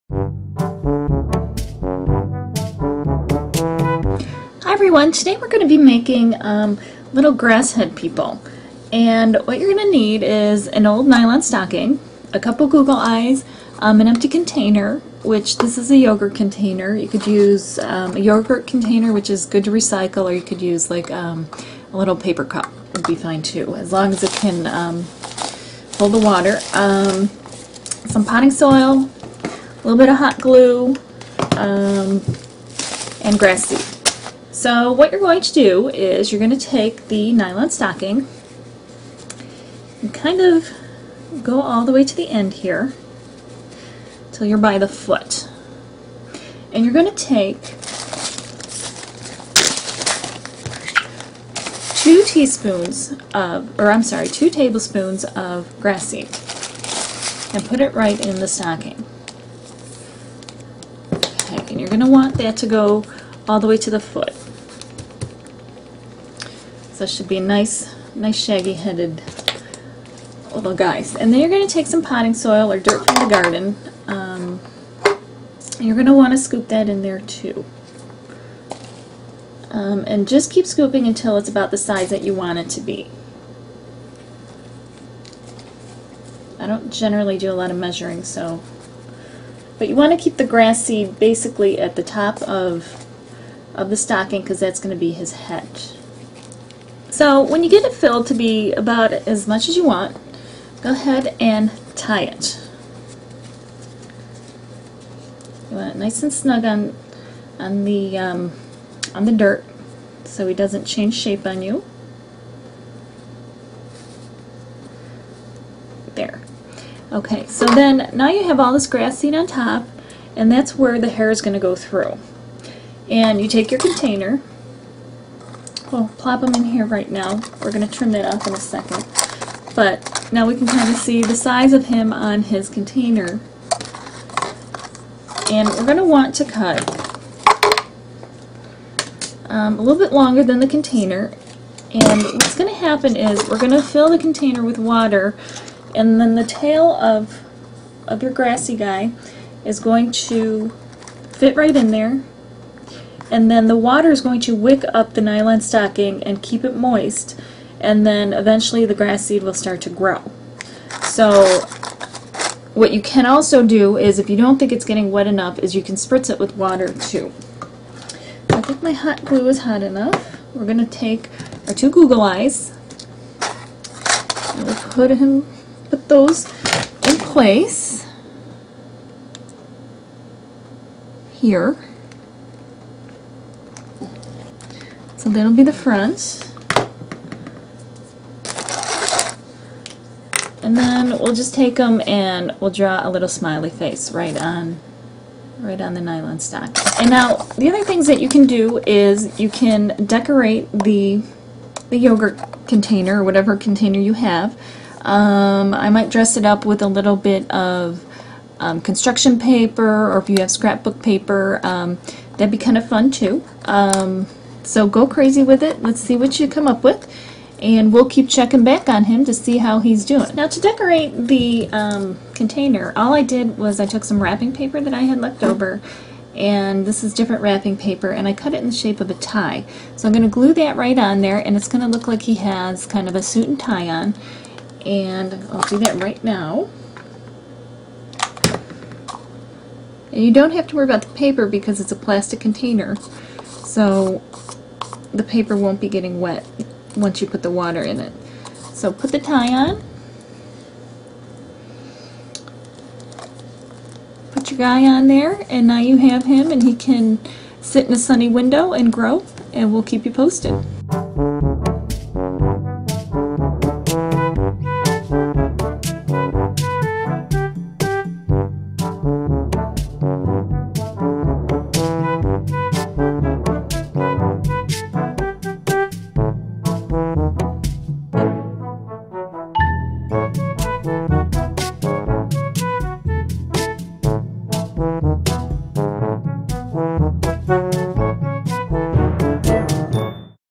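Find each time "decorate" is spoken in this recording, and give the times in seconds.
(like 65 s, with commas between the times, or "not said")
200 s, 220 s.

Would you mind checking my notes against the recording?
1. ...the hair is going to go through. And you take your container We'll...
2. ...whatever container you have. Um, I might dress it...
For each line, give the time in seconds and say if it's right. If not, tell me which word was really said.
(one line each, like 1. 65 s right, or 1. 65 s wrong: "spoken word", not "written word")
1. 120 s right
2. 203 s right.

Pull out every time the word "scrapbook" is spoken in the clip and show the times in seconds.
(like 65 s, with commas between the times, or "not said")
210 s.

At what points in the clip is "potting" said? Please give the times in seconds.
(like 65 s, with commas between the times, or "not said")
28 s, 72 s.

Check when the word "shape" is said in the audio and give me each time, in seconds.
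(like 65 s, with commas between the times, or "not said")
111 s, 228 s.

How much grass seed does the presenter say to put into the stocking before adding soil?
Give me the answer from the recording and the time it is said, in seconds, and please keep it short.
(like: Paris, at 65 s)
2 tablespoons, at 54 s.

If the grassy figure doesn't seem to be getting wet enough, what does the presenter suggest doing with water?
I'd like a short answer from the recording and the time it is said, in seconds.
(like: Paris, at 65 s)
Spritz it, at 165 s.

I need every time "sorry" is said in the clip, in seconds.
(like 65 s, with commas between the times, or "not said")
54 s.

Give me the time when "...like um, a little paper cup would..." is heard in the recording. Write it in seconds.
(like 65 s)
20 s.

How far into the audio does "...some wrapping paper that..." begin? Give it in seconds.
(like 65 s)
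224 s.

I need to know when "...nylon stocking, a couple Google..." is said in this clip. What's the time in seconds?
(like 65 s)
11 s.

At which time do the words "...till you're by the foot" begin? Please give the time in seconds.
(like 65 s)
44 s.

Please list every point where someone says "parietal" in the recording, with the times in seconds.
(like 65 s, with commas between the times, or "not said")
not said.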